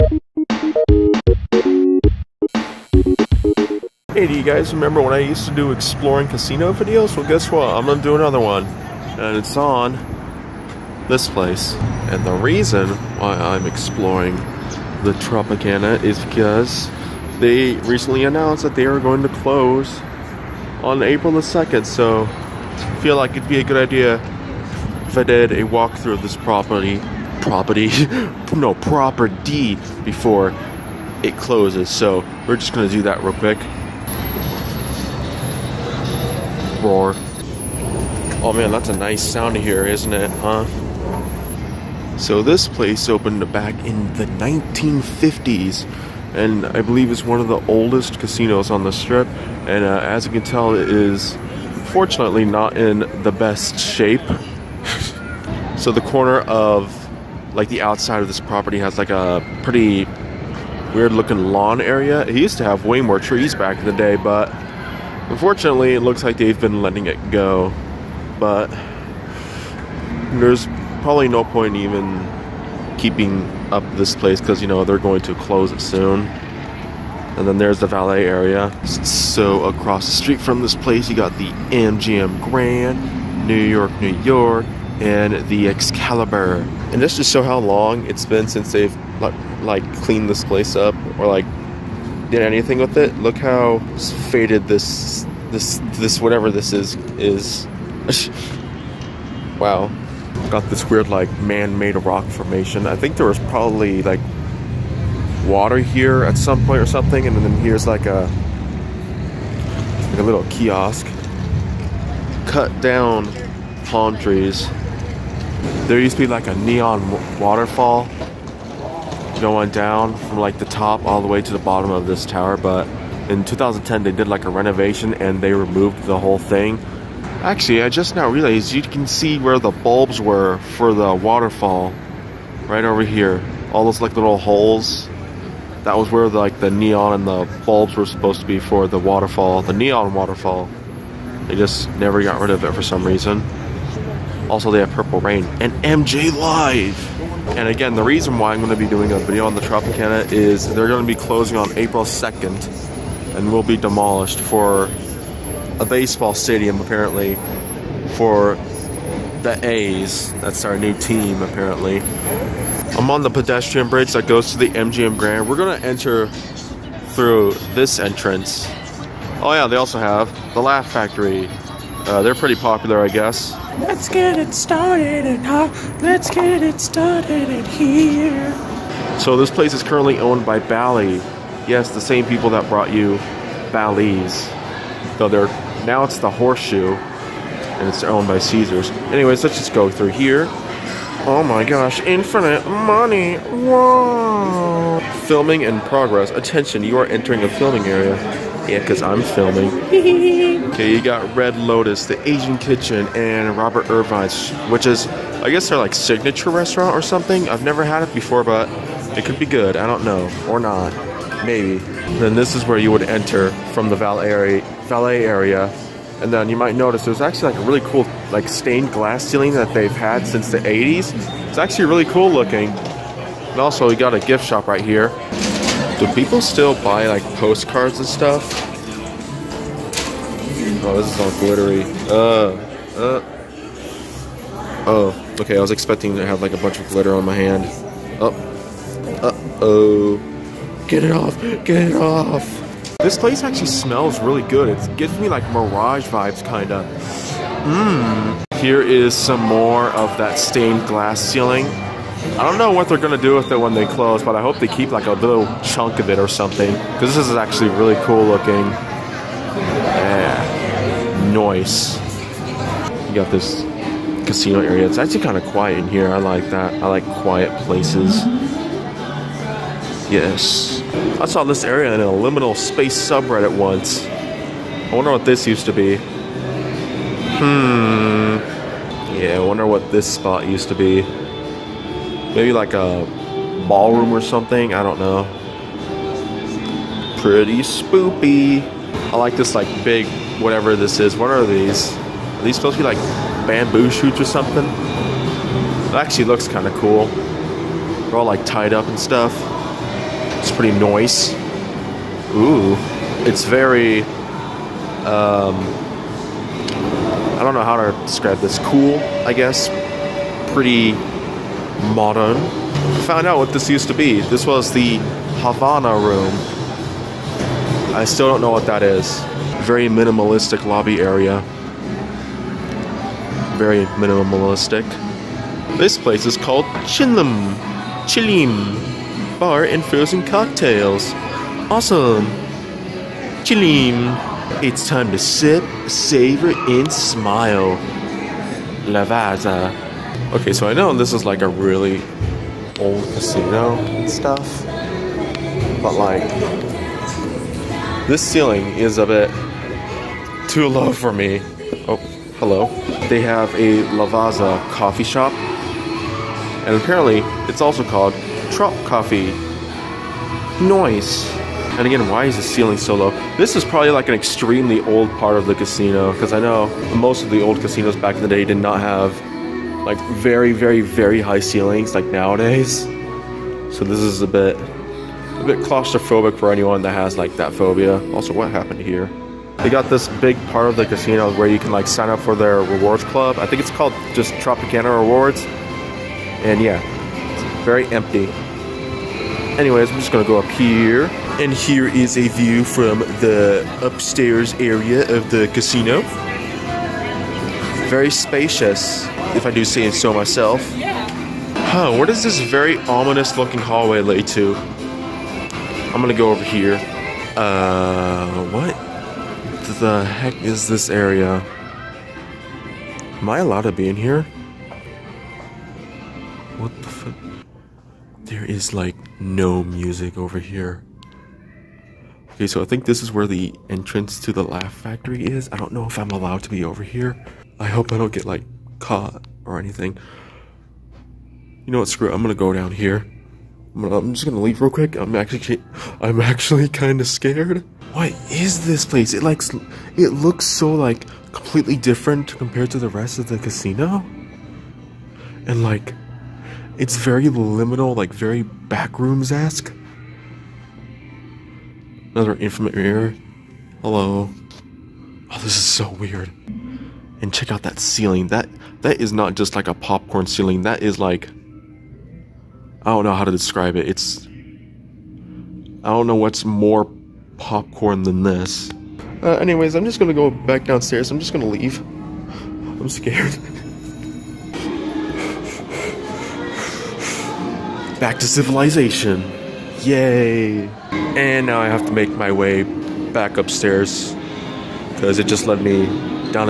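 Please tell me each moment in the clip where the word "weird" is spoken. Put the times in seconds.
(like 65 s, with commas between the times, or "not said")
60 s, 100 s, 455 s.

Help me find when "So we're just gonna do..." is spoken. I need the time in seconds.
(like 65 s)
31 s.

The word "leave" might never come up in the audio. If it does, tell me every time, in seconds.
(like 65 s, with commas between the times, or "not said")
434 s, 471 s.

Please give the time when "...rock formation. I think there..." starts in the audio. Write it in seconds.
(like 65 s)
101 s.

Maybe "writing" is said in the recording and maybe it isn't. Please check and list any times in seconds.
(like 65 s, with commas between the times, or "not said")
not said.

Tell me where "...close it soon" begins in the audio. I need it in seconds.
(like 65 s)
75 s.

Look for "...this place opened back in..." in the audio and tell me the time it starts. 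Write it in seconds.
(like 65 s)
42 s.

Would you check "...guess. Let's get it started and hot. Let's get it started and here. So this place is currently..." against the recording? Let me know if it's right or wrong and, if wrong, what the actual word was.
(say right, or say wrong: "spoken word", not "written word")
right.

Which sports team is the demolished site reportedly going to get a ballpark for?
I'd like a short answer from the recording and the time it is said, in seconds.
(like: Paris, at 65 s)
The A's, at 159 s.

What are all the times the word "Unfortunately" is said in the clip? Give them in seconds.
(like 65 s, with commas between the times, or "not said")
65 s.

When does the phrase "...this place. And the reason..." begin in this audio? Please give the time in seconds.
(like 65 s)
11 s.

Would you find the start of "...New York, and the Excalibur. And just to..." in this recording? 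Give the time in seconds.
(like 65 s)
83 s.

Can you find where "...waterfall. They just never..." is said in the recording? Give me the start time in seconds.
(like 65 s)
140 s.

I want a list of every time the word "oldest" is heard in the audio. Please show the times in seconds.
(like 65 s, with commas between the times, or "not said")
47 s.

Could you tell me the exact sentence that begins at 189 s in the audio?
Anyways, let's just go through here.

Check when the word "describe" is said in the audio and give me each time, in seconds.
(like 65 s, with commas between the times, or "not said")
308 s, 463 s.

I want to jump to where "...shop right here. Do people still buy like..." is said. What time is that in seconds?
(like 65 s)
224 s.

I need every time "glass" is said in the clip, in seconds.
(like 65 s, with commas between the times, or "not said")
218 s, 250 s.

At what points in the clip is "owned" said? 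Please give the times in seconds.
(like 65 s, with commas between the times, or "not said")
180 s, 188 s.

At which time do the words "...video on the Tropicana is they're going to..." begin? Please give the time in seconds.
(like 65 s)
149 s.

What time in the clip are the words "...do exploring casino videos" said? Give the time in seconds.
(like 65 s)
5 s.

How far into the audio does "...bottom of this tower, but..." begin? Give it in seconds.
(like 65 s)
121 s.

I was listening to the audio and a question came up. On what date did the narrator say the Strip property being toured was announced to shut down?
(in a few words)
April 2.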